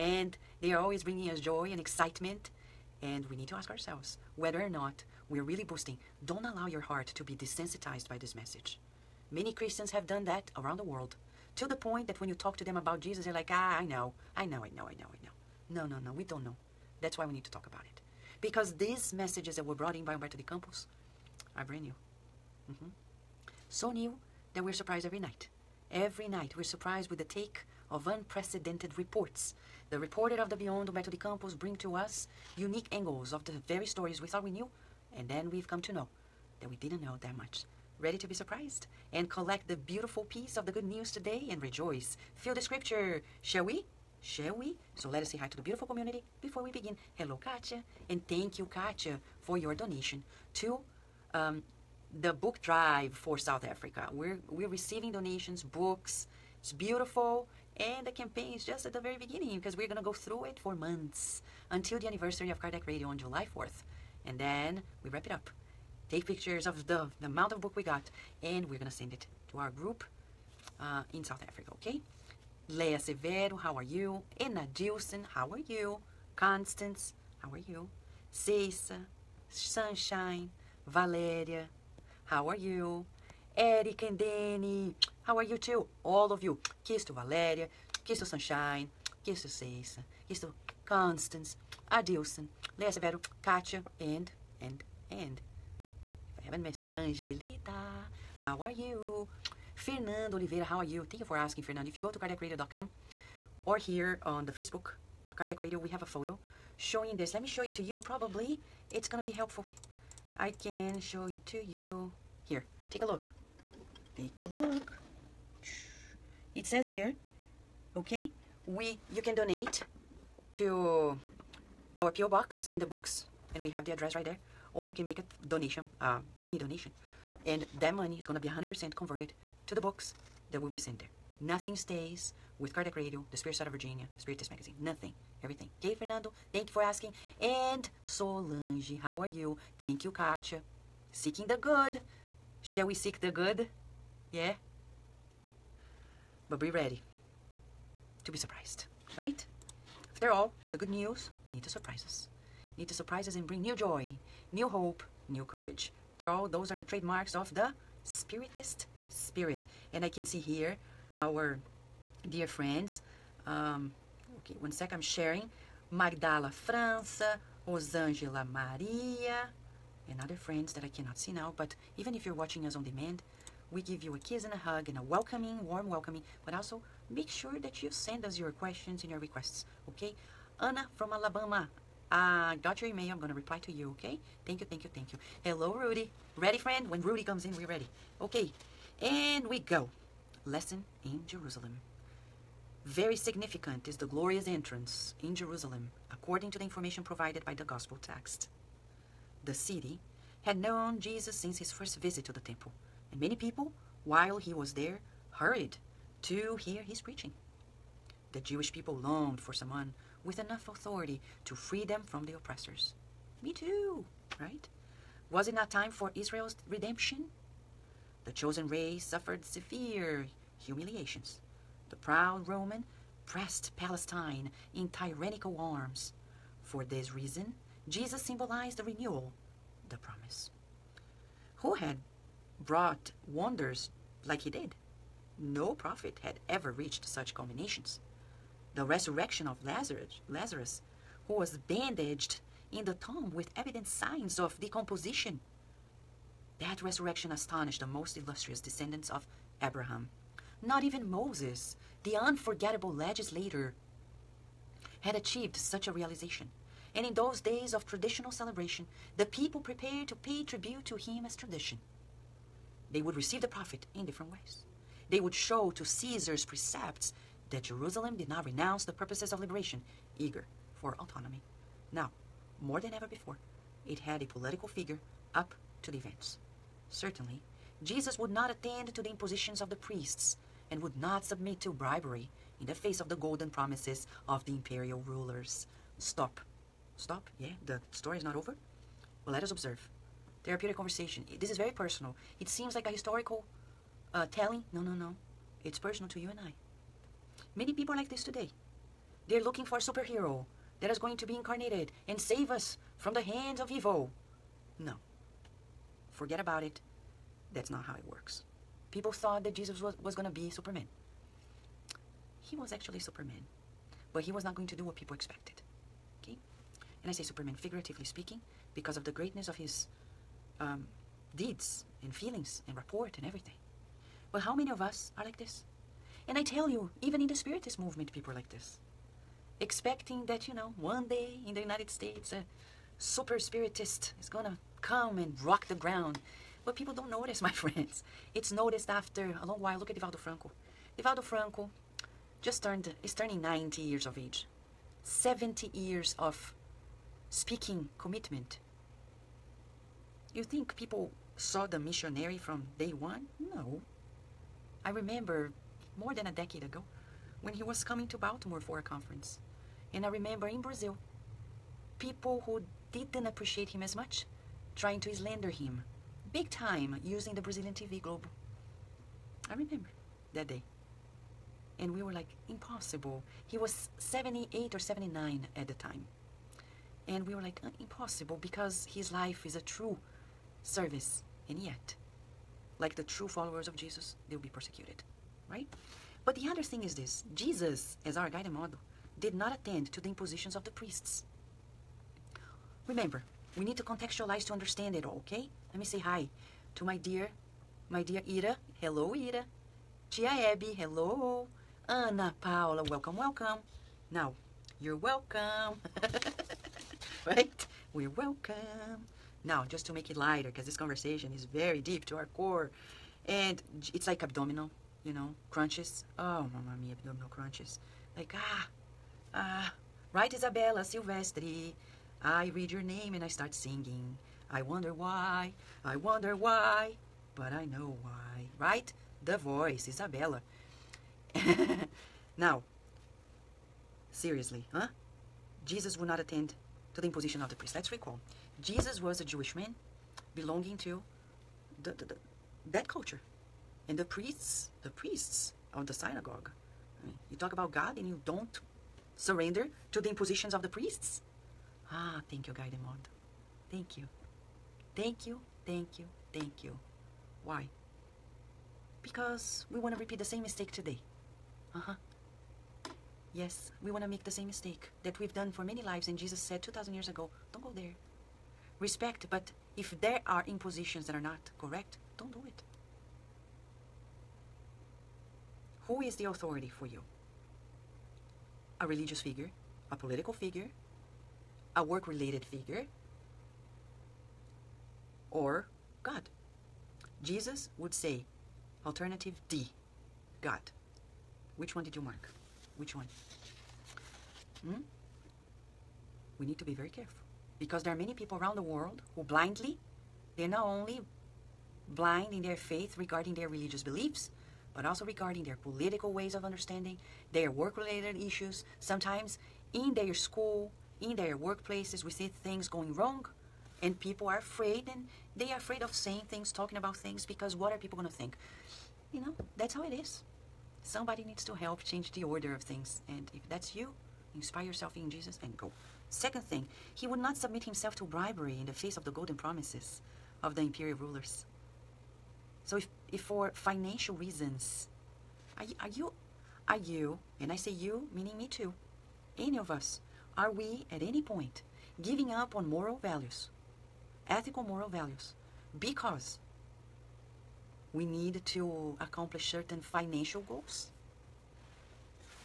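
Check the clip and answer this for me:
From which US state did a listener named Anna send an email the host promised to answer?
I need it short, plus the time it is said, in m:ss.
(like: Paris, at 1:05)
Alabama, at 3:01.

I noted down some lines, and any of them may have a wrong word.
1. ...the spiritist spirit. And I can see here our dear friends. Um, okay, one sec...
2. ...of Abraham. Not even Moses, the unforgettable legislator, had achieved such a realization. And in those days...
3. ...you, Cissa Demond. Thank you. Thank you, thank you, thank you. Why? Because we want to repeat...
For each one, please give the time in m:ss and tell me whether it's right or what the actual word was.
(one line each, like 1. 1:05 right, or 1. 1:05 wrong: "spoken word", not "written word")
1. 2:37 right
2. 4:09 right
3. 7:32 wrong: "Guy", not "Cissa".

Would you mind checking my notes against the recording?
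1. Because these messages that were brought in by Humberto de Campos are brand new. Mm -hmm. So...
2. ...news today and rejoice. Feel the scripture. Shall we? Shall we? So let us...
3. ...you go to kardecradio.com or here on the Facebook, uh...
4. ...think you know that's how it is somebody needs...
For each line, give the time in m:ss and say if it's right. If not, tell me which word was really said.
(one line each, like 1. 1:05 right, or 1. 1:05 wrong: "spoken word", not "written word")
1. 0:18 right
2. 0:40 right
3. 1:41 right
4. 8:38 right.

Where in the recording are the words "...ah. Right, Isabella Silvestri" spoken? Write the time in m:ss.
6:59.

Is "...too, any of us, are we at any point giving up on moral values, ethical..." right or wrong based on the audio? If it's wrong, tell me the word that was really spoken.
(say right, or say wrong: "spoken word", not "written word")
right.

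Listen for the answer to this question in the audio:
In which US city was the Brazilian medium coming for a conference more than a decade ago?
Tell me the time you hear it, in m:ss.
5:58.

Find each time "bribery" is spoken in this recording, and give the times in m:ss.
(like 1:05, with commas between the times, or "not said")
4:41, 8:48.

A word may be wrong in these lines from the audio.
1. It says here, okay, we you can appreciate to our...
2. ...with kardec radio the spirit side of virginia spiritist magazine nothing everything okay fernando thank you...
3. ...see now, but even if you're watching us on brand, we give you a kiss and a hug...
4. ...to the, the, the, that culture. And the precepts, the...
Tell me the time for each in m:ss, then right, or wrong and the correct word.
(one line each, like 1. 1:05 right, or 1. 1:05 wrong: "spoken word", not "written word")
1. 1:56 wrong: "donate", not "appreciate"
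2. 2:12 right
3. 2:51 wrong: "demand", not "brand"
4. 7:20 wrong: "priests", not "precepts".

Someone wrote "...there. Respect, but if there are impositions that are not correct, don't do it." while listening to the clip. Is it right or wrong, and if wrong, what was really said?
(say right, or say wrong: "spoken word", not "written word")
right.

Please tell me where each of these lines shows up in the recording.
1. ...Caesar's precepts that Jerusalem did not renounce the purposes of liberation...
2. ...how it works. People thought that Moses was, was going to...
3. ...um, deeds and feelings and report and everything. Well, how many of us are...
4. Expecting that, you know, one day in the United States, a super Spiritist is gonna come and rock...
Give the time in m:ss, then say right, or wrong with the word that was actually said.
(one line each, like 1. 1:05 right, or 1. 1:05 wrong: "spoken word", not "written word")
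1. 4:25 right
2. 5:07 wrong: "Jesus", not "Moses"
3. 5:20 right
4. 5:29 right.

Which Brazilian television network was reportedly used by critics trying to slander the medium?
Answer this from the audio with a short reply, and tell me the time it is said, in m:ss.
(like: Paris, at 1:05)
TV Globo, at 6:07.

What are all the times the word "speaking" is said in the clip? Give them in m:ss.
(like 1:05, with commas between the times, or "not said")
5:18, 5:47.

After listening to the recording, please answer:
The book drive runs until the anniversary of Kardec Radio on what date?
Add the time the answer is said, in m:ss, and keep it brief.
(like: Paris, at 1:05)
July 4th, at 1:03.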